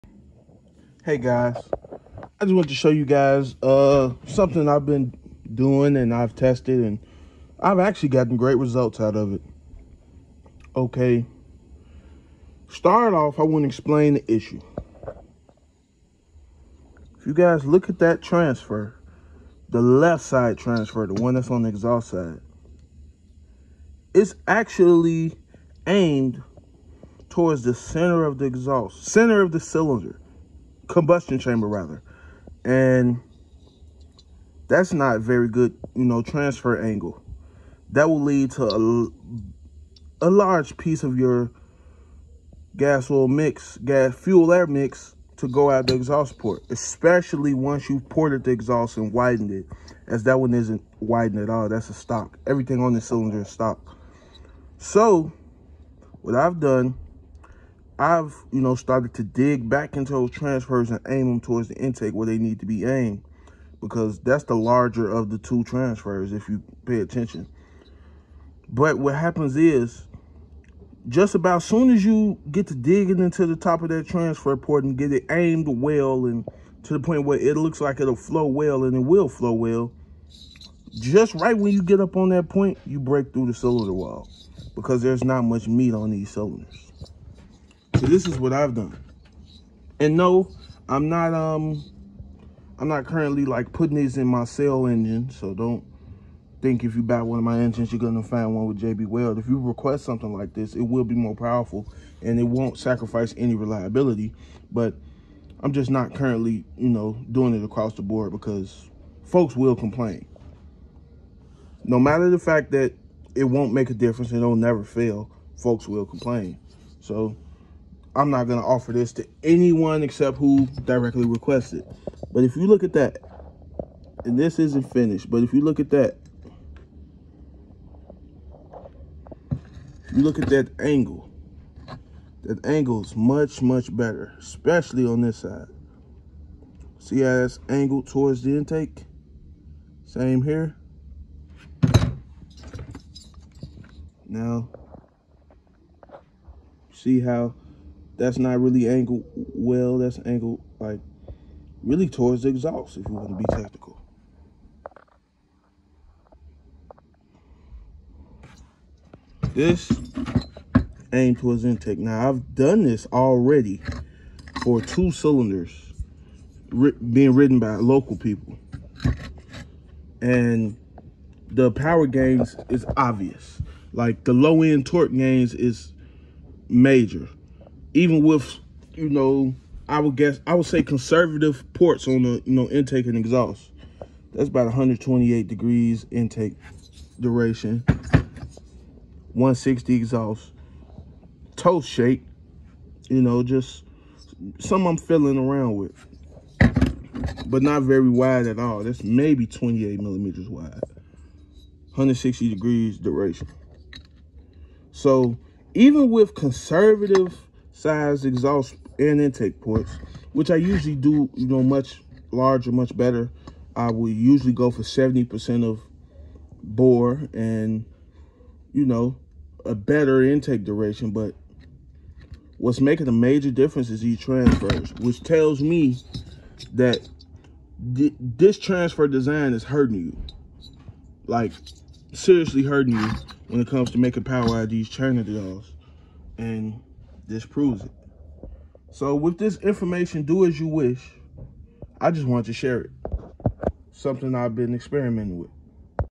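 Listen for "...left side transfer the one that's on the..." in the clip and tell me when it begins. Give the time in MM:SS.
00:19.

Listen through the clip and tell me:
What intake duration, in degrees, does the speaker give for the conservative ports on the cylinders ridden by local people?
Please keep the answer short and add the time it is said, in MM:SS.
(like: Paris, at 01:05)
128 degrees, at 03:04.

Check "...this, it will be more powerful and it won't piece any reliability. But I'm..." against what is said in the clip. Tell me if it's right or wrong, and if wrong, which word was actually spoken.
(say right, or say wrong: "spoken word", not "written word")
wrong: "sacrifice", not "piece".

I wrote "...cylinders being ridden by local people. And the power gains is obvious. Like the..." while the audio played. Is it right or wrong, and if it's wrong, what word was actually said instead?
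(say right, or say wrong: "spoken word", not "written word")
right.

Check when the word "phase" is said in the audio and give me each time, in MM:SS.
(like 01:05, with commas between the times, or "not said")
not said.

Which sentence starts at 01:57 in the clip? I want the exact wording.
So I'm not going to offer this to anyone except who directly requested.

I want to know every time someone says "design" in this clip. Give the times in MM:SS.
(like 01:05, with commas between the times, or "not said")
03:49.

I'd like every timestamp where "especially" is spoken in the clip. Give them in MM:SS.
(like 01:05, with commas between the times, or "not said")
00:46, 02:14.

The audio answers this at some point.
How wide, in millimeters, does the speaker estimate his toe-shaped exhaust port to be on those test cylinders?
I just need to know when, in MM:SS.
03:19.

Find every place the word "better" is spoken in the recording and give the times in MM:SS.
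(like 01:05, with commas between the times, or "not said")
02:13, 03:32, 03:39.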